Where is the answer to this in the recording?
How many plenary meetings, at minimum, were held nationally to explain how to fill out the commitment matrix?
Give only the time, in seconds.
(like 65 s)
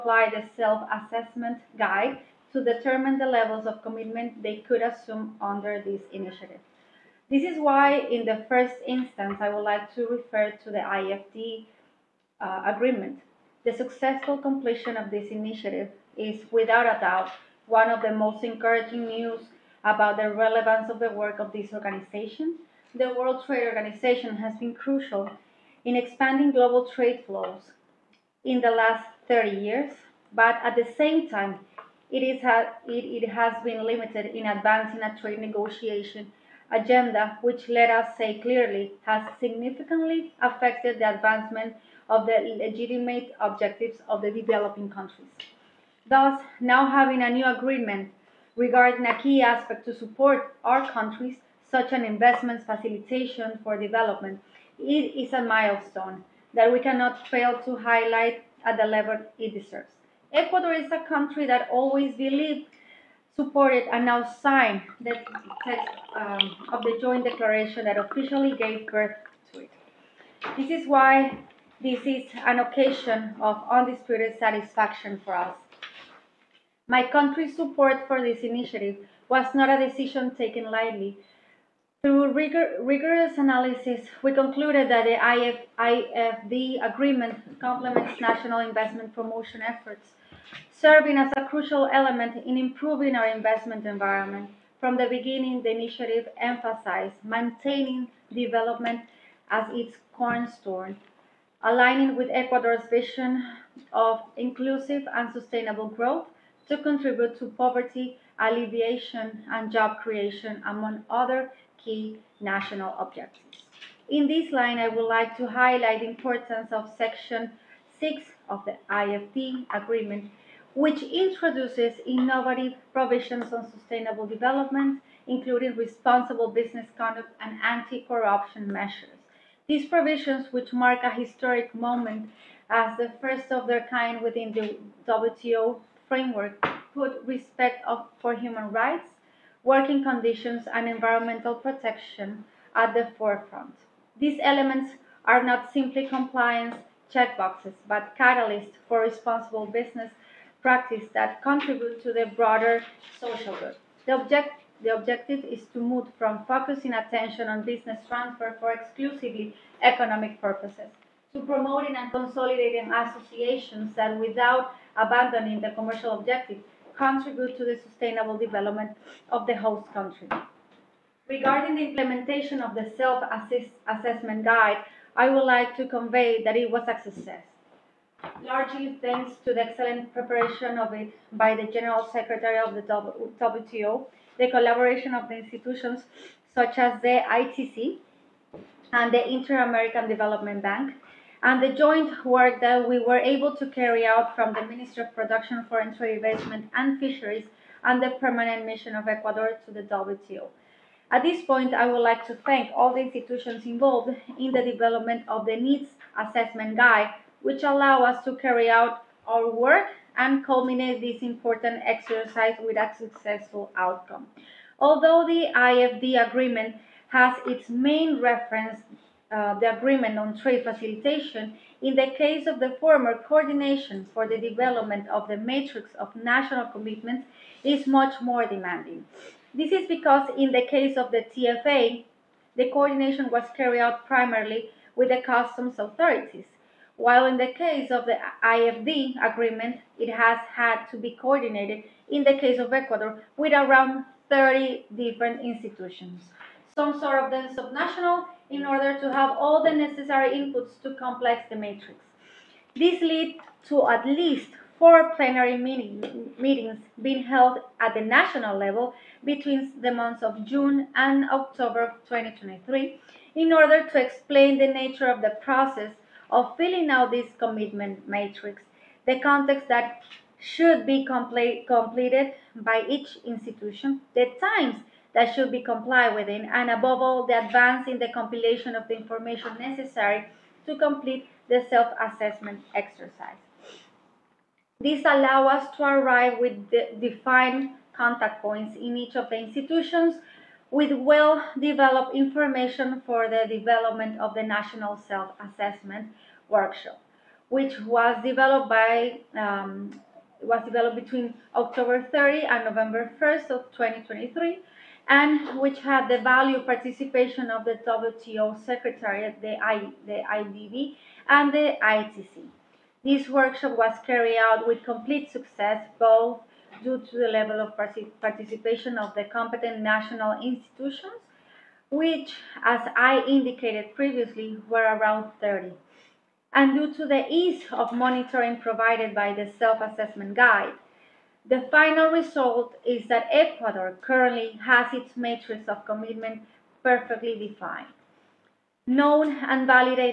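254 s.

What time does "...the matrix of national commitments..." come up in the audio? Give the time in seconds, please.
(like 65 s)
225 s.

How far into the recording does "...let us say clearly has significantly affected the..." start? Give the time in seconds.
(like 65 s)
37 s.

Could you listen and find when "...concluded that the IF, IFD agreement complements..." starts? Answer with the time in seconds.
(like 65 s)
84 s.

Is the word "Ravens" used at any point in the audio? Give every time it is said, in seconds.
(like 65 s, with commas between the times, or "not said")
not said.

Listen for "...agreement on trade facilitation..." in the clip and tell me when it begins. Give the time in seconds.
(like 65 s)
219 s.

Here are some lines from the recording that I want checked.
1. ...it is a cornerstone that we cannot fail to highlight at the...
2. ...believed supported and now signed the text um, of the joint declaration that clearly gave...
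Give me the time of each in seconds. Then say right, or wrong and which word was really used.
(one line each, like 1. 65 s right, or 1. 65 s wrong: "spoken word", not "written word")
1. 54 s wrong: "milestone", not "cornerstone"
2. 62 s wrong: "officially", not "clearly".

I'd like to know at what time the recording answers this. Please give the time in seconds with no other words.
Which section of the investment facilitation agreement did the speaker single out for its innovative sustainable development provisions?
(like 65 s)
116 s.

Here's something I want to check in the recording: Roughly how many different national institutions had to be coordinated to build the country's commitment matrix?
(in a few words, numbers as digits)
30.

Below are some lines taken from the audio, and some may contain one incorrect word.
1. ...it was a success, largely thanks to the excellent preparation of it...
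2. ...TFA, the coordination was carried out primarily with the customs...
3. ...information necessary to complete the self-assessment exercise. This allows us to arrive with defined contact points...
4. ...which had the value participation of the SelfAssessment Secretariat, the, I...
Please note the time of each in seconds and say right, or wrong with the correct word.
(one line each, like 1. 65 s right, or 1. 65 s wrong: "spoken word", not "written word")
1. 176 s right
2. 231 s right
3. 278 s right
4. 305 s wrong: "WTO", not "SelfAssessment".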